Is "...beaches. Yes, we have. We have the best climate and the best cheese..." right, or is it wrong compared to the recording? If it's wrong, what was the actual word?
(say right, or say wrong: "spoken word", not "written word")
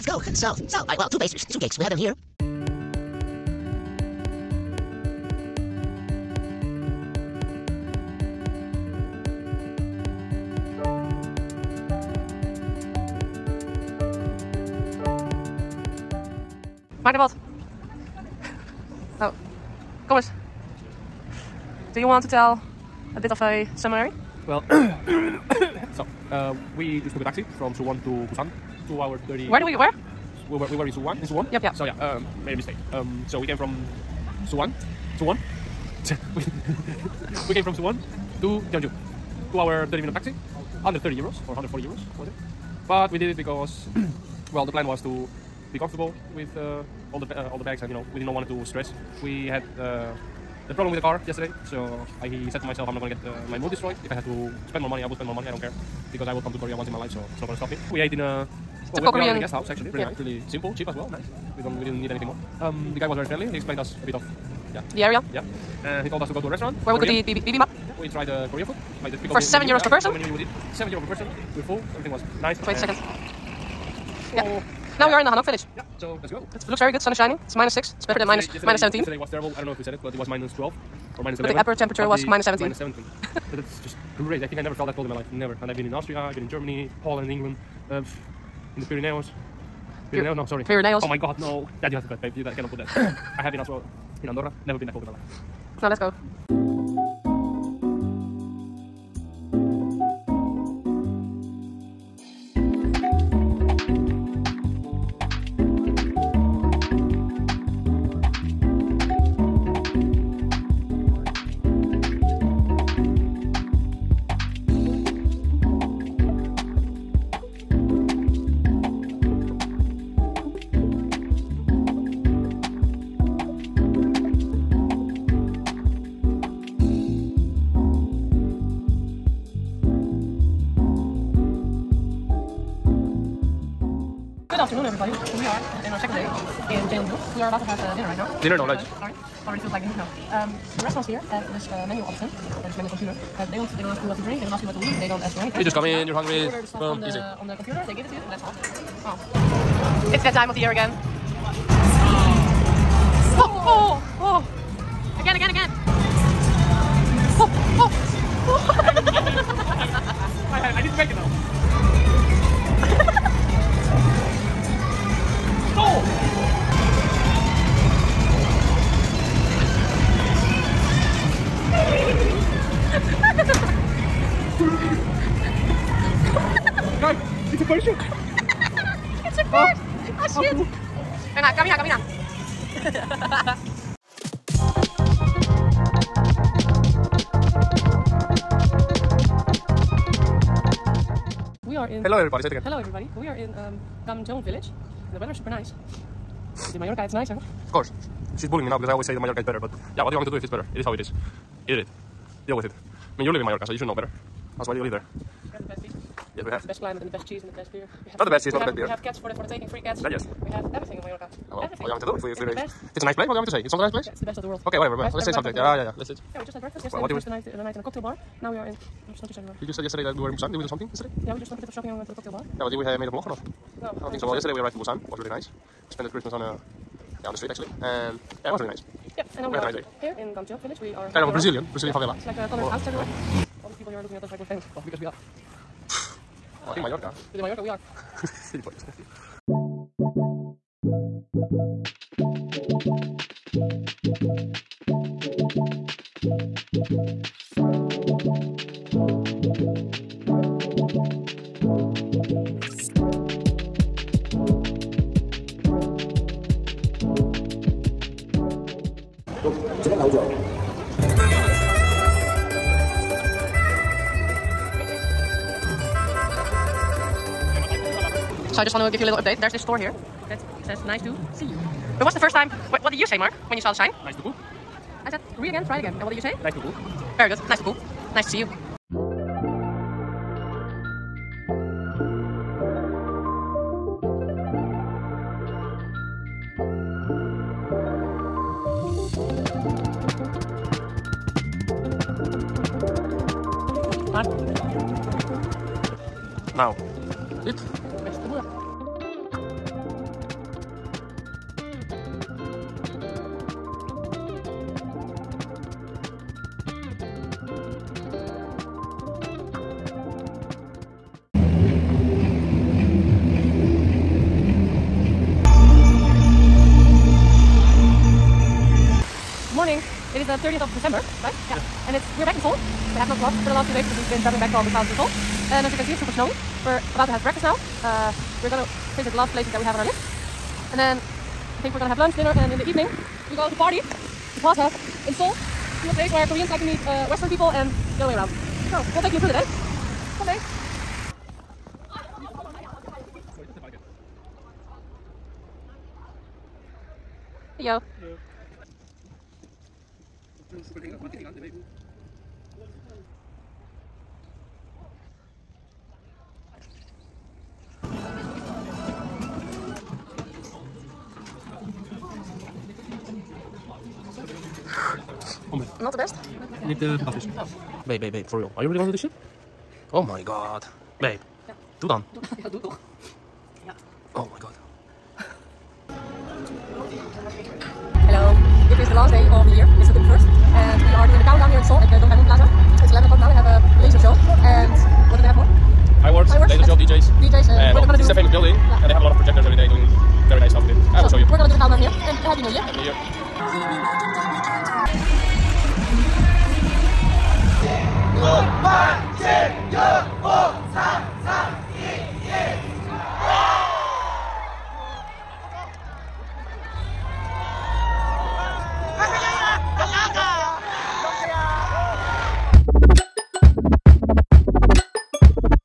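right.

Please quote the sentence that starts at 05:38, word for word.
So we'll take you through the day.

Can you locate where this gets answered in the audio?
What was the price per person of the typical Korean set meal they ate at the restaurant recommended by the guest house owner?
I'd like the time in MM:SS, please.
01:10.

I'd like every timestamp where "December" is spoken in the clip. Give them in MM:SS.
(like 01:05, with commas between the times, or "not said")
05:20.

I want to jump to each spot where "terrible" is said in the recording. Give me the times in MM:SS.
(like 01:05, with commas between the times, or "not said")
01:19.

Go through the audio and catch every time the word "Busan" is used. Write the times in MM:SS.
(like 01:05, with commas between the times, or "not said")
00:28, 03:40, 03:44, 05:24.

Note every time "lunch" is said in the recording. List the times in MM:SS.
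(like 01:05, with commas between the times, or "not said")
02:18, 05:31.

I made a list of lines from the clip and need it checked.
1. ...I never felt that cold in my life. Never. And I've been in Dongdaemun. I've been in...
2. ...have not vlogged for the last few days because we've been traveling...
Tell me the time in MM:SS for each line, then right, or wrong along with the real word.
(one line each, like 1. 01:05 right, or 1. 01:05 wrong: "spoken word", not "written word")
1. 01:24 wrong: "Austria", not "Dongdaemun"
2. 05:22 right.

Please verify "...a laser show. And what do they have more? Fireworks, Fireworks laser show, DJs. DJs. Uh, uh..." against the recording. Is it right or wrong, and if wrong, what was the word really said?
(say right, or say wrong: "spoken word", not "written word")
right.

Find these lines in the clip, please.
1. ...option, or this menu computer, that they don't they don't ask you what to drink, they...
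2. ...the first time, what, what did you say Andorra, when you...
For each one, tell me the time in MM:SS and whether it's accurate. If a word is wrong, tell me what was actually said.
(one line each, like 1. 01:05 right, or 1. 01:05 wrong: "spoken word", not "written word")
1. 02:22 right
2. 04:32 wrong: "Mark", not "Andorra".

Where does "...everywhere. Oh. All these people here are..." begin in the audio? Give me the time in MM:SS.
03:52.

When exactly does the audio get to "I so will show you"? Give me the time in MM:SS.
06:30.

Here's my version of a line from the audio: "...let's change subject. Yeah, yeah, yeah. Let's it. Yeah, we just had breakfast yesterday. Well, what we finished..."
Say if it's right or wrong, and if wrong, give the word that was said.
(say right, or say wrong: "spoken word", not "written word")
right.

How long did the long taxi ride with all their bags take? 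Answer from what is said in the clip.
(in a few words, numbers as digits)
2 hours 30.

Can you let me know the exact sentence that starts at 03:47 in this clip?
And yeah, it was really nice.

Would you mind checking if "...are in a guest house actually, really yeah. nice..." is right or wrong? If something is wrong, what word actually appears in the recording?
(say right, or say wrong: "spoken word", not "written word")
right.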